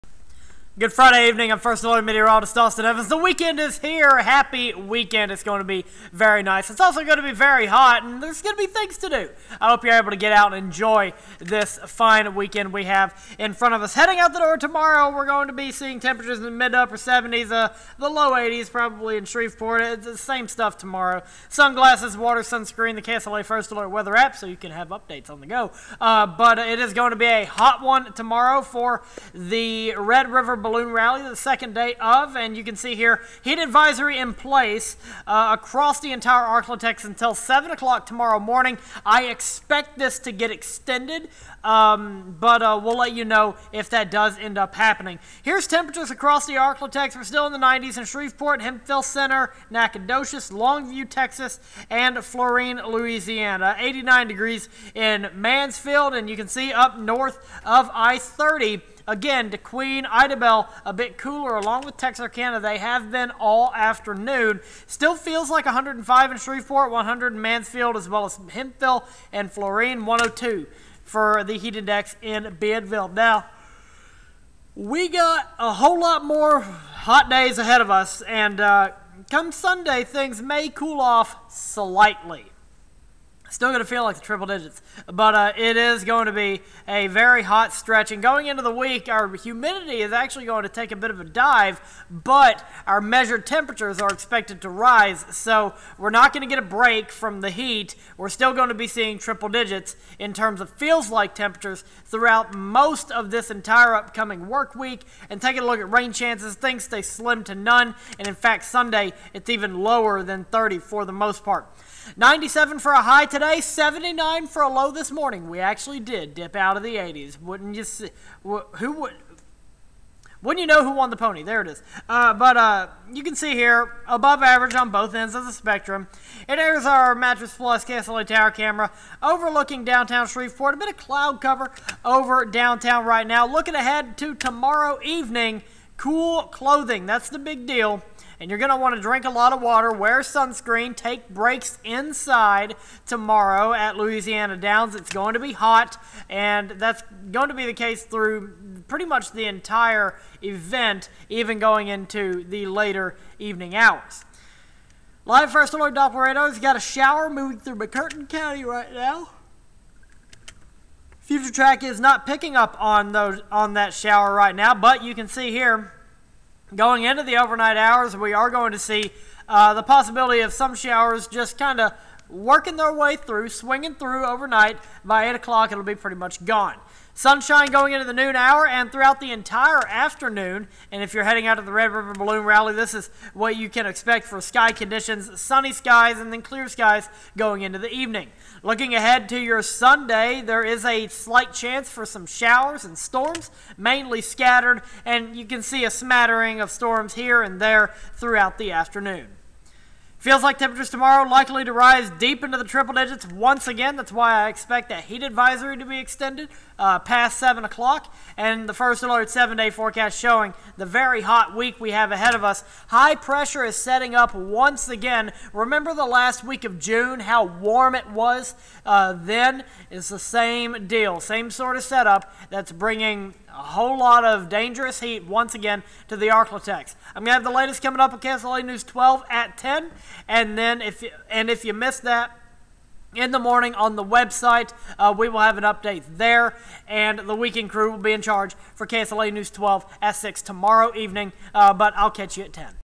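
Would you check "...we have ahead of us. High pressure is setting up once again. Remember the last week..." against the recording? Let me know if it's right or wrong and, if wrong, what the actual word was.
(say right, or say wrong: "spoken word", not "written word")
right.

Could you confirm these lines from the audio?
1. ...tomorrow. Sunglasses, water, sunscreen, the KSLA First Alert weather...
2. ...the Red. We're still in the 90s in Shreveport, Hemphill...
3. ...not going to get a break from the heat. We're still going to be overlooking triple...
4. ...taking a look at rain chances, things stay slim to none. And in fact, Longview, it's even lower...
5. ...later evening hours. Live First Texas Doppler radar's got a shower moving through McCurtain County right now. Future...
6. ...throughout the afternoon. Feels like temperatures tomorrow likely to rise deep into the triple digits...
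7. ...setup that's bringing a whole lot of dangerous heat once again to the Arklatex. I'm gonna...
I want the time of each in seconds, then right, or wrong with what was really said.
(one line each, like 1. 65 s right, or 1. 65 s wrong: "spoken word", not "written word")
1. 20 s right
2. 46 s wrong: "Arklatex", not "Red"
3. 96 s wrong: "seeing", not "overlooking"
4. 105 s wrong: "Sunday", not "Longview"
5. 152 s wrong: "Alert", not "Texas"
6. 198 s right
7. 221 s right.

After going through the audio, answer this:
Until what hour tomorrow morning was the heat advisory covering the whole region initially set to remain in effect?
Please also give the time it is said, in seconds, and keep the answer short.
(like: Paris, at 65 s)
7 o'clock, at 37 s.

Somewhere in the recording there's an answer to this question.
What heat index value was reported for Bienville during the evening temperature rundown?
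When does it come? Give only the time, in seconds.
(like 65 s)
70 s.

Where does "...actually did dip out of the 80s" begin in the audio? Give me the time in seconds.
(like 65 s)
115 s.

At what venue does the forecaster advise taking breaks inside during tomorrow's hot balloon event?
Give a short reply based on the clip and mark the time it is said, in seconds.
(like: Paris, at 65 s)
Louisiana Downs, at 143 s.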